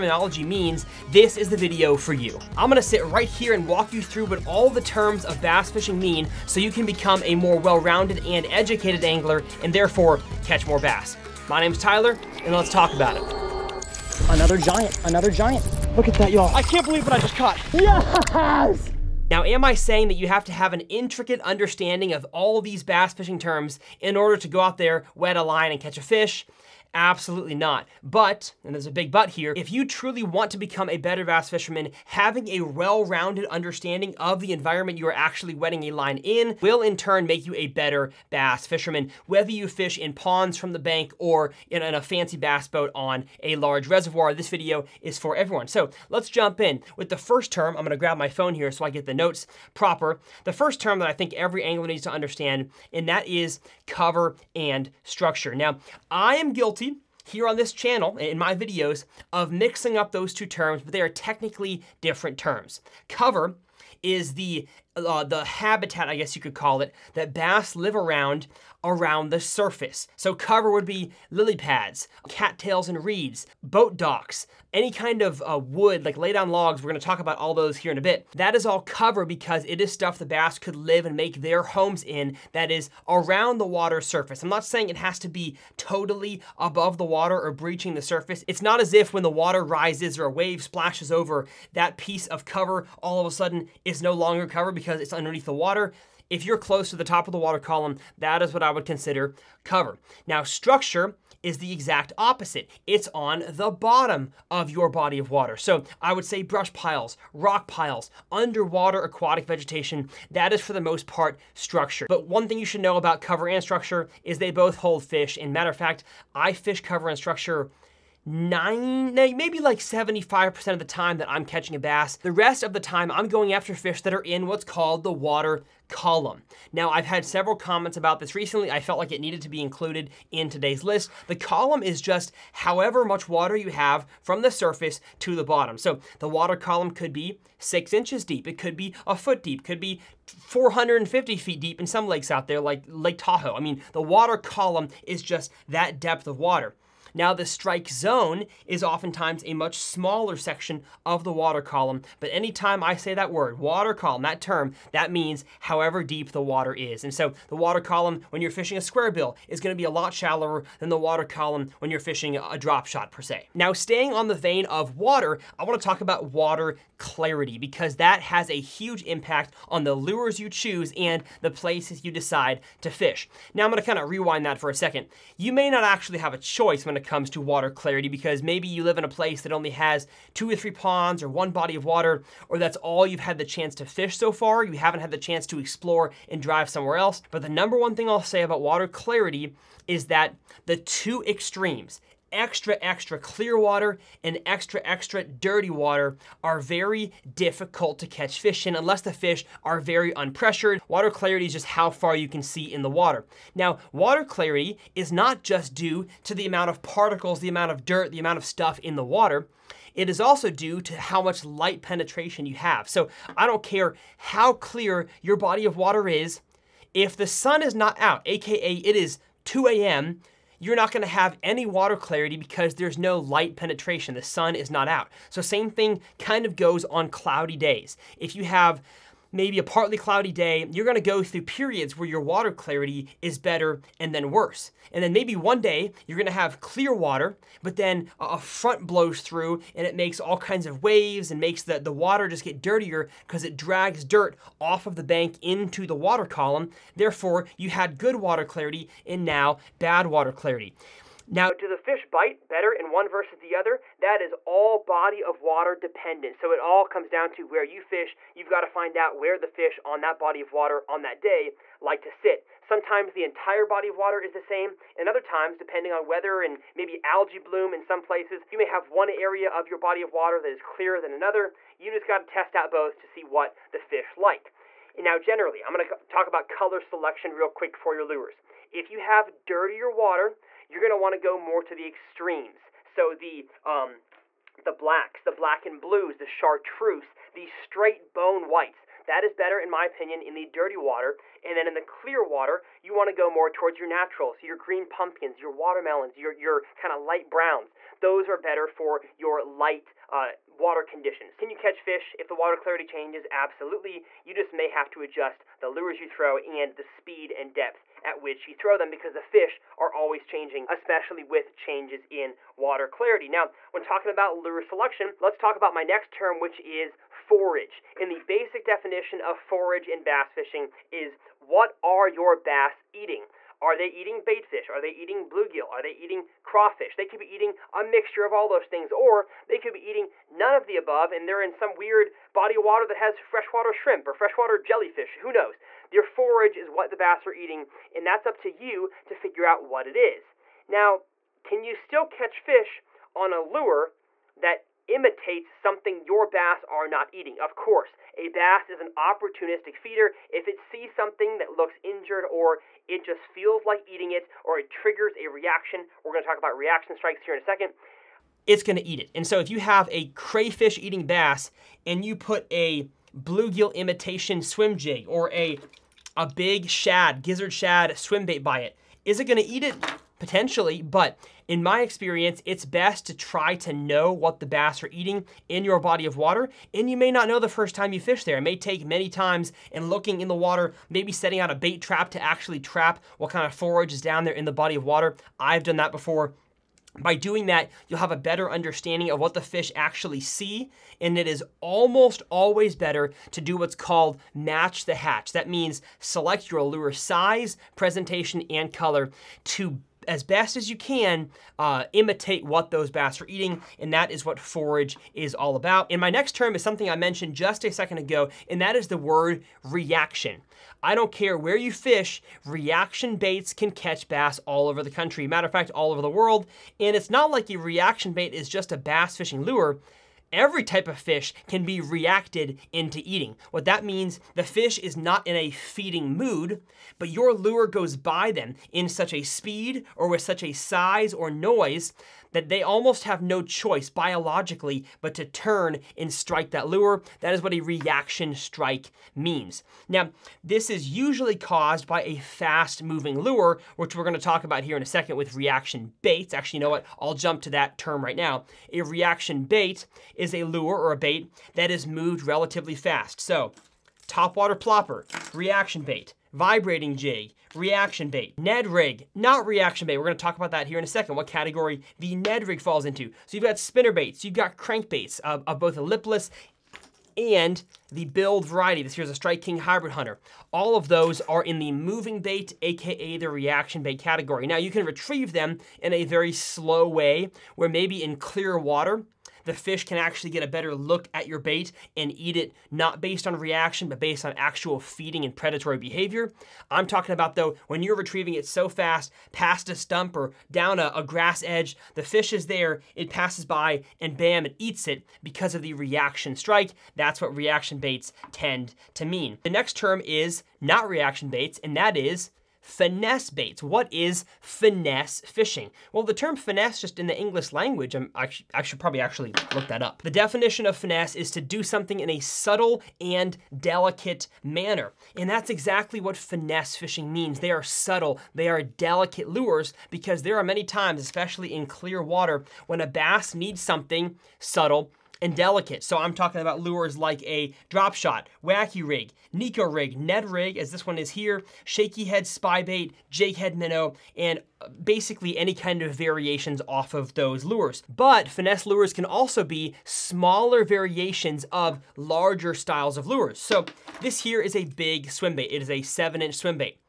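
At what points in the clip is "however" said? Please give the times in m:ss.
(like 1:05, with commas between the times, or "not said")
2:12, 2:35.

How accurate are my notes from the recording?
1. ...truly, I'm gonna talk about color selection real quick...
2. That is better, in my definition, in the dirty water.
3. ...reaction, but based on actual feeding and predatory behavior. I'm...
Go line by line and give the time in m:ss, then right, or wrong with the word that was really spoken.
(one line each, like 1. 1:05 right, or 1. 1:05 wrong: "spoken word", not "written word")
1. 4:35 wrong: "generally", not "truly"
2. 4:49 wrong: "opinion", not "definition"
3. 8:03 right.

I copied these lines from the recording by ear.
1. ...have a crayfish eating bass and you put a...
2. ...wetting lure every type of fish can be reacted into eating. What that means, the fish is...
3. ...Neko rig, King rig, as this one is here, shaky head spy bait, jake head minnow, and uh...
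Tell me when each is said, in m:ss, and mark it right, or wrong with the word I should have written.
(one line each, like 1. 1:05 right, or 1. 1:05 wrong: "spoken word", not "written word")
1. 5:59 right
2. 6:59 wrong: "fishing", not "wetting"
3. 8:49 wrong: "Ned", not "King".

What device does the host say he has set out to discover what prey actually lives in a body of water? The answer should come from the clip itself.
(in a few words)
A bait trap.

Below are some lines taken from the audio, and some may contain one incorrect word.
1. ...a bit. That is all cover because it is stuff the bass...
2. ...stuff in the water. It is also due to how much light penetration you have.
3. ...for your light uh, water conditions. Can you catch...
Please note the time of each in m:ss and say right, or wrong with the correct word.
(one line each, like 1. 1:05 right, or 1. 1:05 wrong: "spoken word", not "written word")
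1. 1:17 right
2. 3:28 right
3. 4:58 right.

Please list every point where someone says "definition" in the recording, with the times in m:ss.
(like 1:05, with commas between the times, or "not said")
5:18, 8:30.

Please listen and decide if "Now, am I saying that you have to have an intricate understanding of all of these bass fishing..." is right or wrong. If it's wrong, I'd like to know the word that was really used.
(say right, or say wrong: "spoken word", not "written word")
right.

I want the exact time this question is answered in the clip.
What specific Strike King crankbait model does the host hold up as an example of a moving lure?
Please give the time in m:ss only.
7:49.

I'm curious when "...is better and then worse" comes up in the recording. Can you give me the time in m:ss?
3:53.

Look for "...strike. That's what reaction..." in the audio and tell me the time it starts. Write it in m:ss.
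8:16.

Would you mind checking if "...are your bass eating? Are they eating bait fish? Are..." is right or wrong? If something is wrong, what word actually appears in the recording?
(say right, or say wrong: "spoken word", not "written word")
right.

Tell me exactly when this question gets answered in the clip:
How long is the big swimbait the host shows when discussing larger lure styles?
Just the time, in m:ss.
9:05.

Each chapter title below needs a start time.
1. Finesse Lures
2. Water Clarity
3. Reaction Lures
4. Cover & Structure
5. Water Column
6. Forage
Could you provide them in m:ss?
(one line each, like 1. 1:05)
1. 8:20
2. 2:45
3. 6:48
4. 0:53
5. 2:04
6. 5:16.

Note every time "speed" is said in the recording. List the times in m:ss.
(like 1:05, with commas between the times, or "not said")
5:06, 7:09.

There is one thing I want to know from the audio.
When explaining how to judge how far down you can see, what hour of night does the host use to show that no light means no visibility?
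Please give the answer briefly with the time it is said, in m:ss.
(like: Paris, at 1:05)
2 a.m., at 3:39.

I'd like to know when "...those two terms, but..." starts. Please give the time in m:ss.
1:00.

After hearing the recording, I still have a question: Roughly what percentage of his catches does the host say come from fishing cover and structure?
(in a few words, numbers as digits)
75%.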